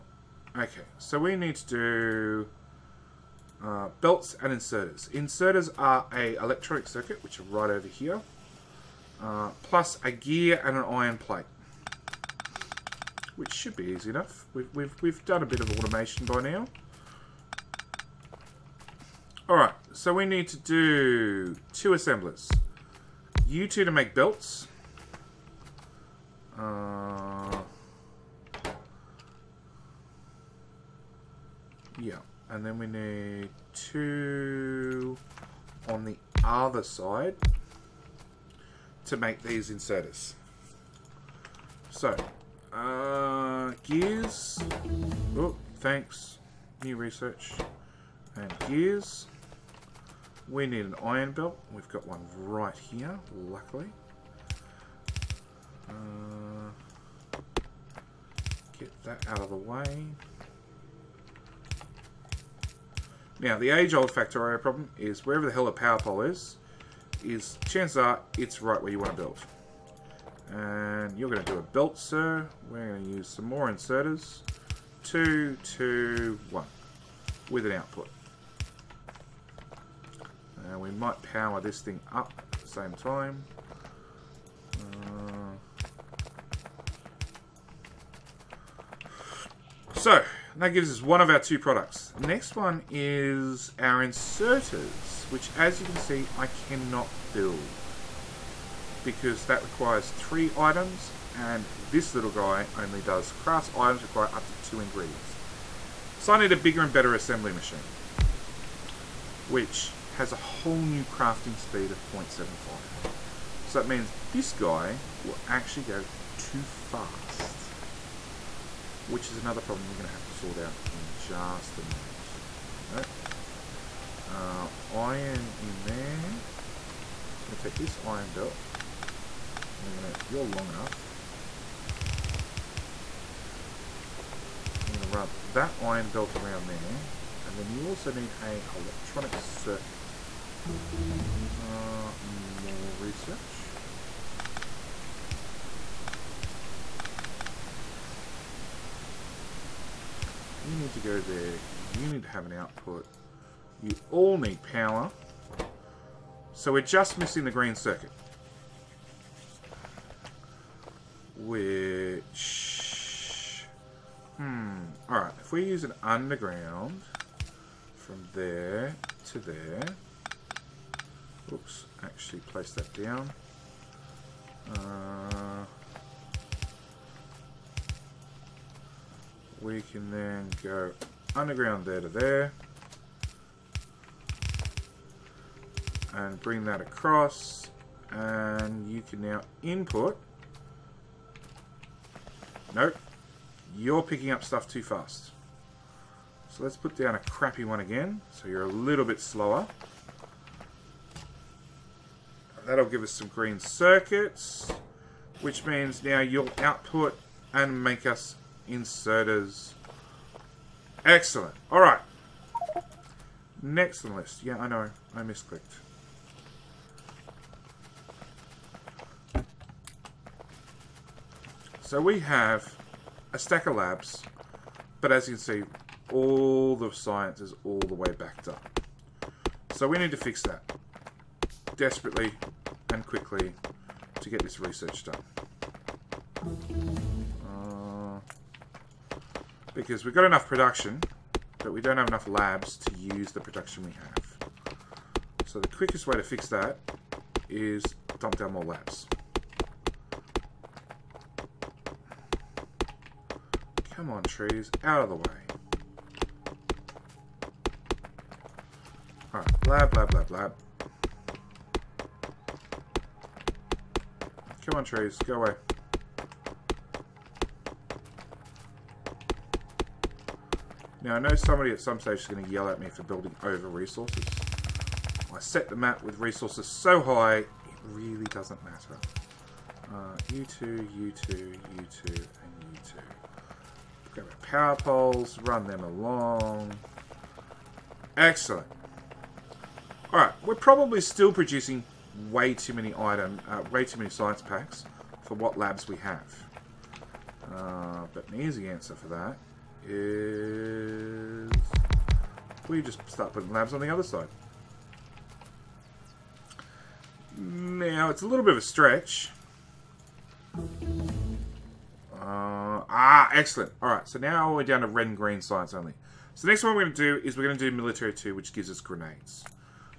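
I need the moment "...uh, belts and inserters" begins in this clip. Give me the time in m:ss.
0:03.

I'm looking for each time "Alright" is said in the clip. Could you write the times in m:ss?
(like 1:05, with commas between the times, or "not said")
0:19, 2:45, 4:19, 4:50.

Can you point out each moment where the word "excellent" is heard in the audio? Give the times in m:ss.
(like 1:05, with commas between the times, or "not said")
3:31, 4:48, 5:13.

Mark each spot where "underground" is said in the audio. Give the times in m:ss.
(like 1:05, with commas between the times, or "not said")
2:46, 3:01.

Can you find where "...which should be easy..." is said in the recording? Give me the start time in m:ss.
0:13.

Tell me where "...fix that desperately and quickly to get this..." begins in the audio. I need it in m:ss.
3:50.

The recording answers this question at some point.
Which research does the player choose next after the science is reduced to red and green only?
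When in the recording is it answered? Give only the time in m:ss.
5:17.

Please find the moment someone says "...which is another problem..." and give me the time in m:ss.
1:59.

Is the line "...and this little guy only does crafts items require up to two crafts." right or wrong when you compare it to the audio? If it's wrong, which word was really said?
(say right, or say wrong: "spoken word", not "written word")
wrong: "ingredients", not "crafts".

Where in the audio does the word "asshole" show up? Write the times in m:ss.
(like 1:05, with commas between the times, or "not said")
not said.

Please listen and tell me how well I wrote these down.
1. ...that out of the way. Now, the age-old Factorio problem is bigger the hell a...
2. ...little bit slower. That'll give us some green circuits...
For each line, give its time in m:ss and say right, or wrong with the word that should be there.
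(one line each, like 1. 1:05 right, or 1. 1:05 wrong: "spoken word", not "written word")
1. 0:59 wrong: "wherever", not "bigger"
2. 3:18 right.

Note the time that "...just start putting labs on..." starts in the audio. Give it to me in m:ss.
5:02.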